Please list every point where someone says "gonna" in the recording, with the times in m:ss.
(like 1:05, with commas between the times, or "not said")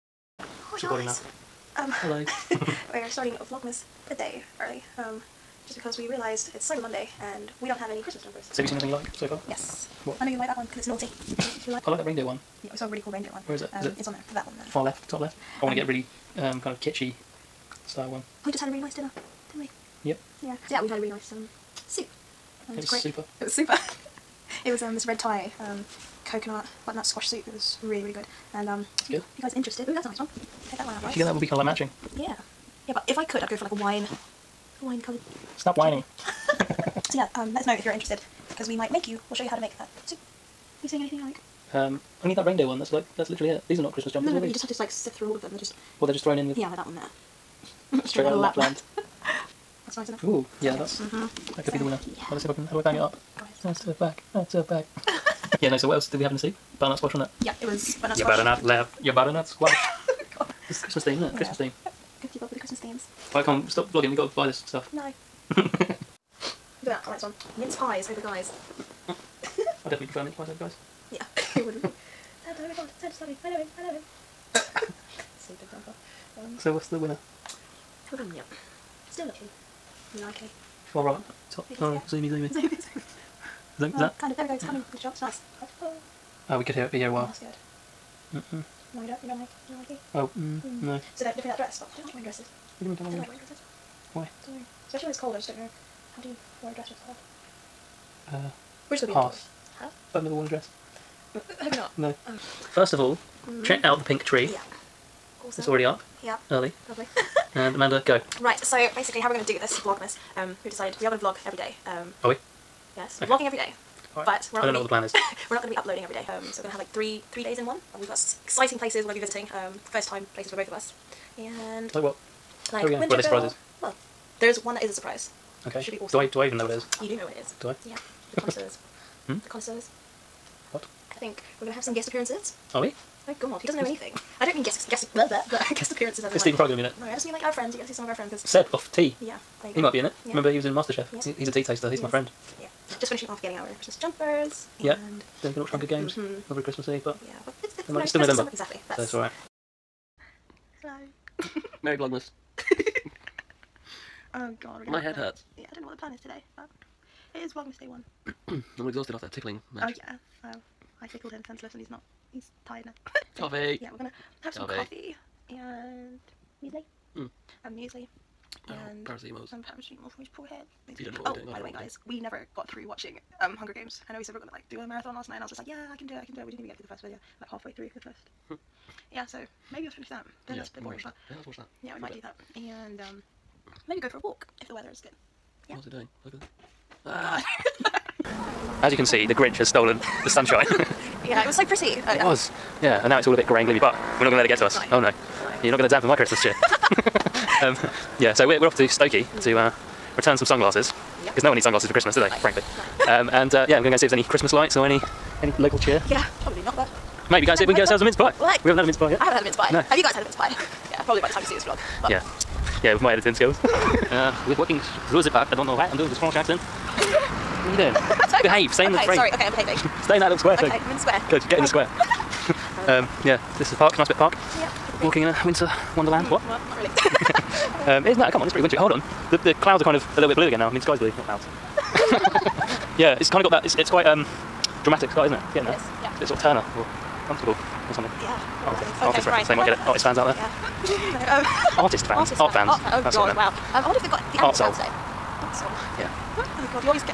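1:39, 2:43, 2:54.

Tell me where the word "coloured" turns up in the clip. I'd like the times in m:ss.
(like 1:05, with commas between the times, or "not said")
0:35.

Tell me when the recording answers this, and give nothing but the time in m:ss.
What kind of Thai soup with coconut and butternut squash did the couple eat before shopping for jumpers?
0:25.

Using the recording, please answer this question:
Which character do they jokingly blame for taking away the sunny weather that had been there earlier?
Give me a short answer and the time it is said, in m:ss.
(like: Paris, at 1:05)
The Grinch, at 3:09.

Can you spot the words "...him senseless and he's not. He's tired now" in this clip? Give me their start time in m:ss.
2:41.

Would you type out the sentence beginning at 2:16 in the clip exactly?
Is like, Stephen Fry going to be in it?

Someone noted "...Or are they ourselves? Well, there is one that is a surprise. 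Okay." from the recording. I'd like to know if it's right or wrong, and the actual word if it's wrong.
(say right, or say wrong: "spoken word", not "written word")
wrong: "surprises", not "ourselves".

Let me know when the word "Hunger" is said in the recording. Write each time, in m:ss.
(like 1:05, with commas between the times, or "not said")
2:25, 2:53.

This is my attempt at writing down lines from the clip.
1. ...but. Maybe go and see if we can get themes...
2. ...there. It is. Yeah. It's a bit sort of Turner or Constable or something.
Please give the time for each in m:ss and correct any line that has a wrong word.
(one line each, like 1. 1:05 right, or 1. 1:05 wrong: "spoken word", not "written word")
1. 3:26 wrong: "ourselves", not "themes"
2. 3:55 right.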